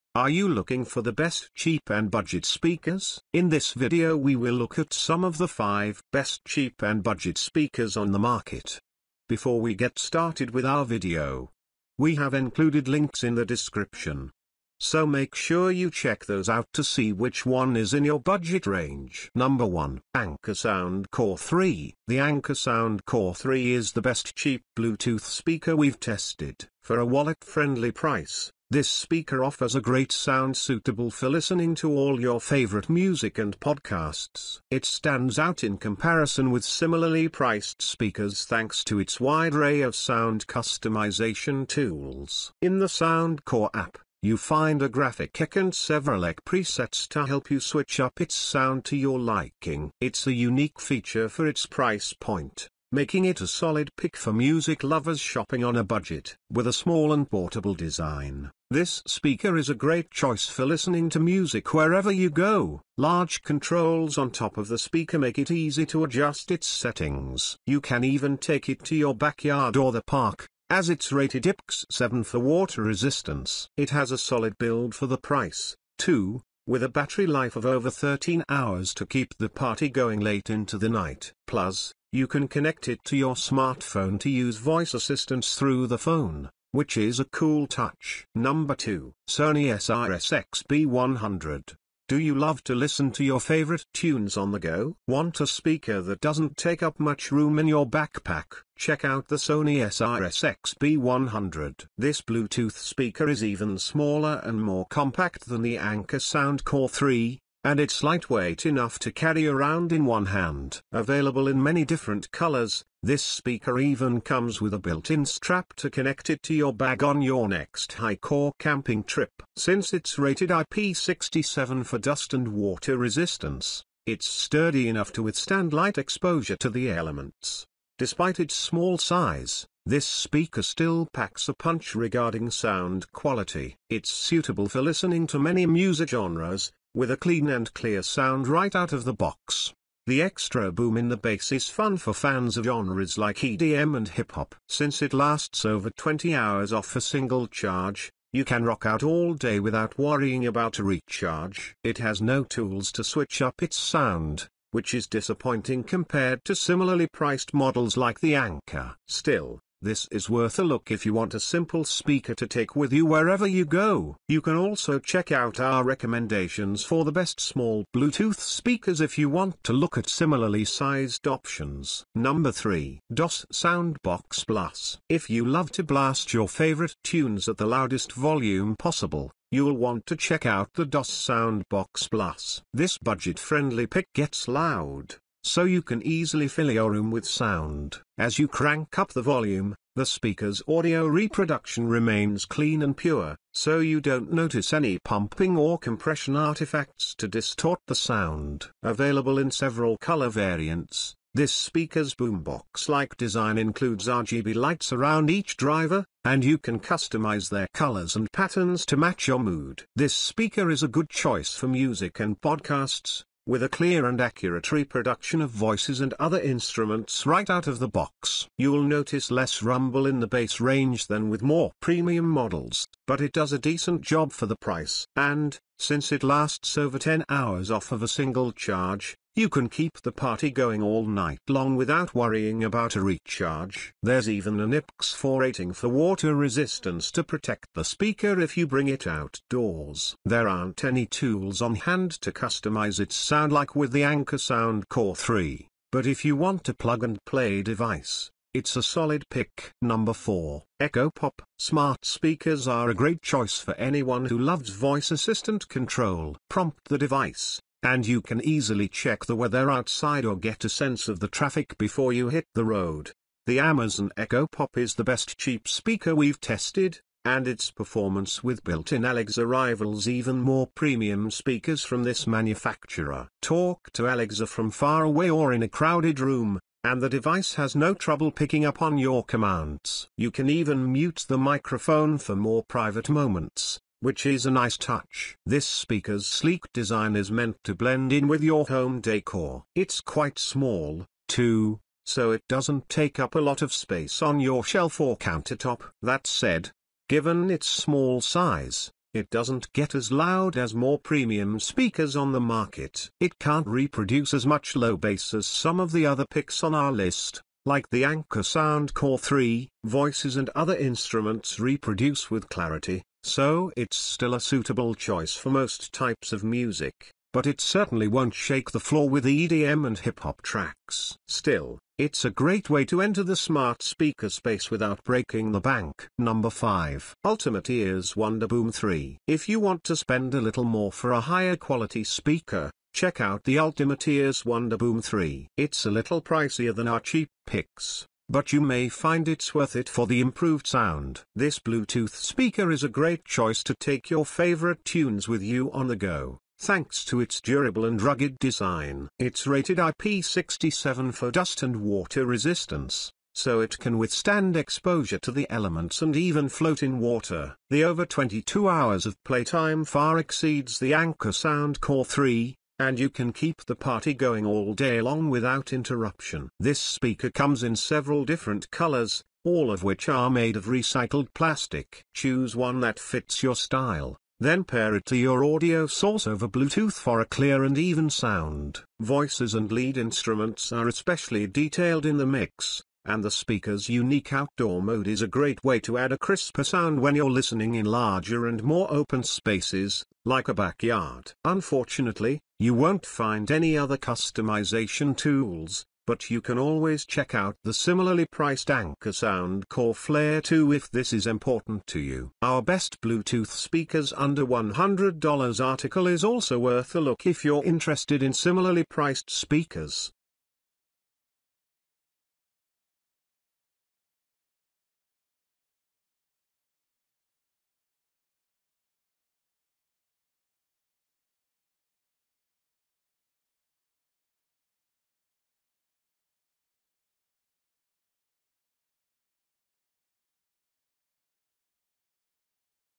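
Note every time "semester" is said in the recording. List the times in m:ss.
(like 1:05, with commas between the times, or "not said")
not said.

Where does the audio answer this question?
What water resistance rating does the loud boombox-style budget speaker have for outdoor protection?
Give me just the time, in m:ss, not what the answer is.
3:54.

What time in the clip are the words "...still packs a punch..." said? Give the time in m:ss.
2:10.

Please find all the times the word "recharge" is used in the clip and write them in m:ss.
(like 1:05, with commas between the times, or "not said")
2:30, 3:53.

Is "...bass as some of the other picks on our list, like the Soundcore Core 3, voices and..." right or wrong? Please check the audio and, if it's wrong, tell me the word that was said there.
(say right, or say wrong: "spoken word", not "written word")
wrong: "Anker", not "Soundcore".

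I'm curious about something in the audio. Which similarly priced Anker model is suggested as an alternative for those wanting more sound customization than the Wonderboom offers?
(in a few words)
Anker Soundcore Flare 2.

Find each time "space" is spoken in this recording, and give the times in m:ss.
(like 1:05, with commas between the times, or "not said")
4:53, 5:24, 6:29.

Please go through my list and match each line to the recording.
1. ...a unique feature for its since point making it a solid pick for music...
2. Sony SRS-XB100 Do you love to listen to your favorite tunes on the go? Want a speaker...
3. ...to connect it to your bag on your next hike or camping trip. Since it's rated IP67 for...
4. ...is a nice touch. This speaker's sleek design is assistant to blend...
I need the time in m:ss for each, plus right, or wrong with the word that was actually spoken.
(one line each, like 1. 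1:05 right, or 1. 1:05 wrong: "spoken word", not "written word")
1. 0:50 wrong: "price", not "since"
2. 1:29 right
3. 1:55 right
4. 4:44 wrong: "meant", not "assistant".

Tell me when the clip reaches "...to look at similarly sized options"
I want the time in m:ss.
2:49.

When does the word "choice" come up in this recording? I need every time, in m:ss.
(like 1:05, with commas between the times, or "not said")
1:00, 3:31, 4:13, 5:14, 5:43.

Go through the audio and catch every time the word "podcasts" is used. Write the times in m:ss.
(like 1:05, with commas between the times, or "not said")
0:33, 3:32.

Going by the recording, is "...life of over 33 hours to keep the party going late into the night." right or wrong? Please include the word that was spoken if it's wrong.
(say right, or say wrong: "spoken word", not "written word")
wrong: "13", not "33".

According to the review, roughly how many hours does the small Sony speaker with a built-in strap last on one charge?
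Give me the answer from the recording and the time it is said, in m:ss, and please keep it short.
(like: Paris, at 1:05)
20 hours, at 2:25.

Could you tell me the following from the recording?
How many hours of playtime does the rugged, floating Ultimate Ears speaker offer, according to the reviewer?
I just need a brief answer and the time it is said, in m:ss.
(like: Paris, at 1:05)
22 hours, at 5:58.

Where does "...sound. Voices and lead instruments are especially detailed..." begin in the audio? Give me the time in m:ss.
6:18.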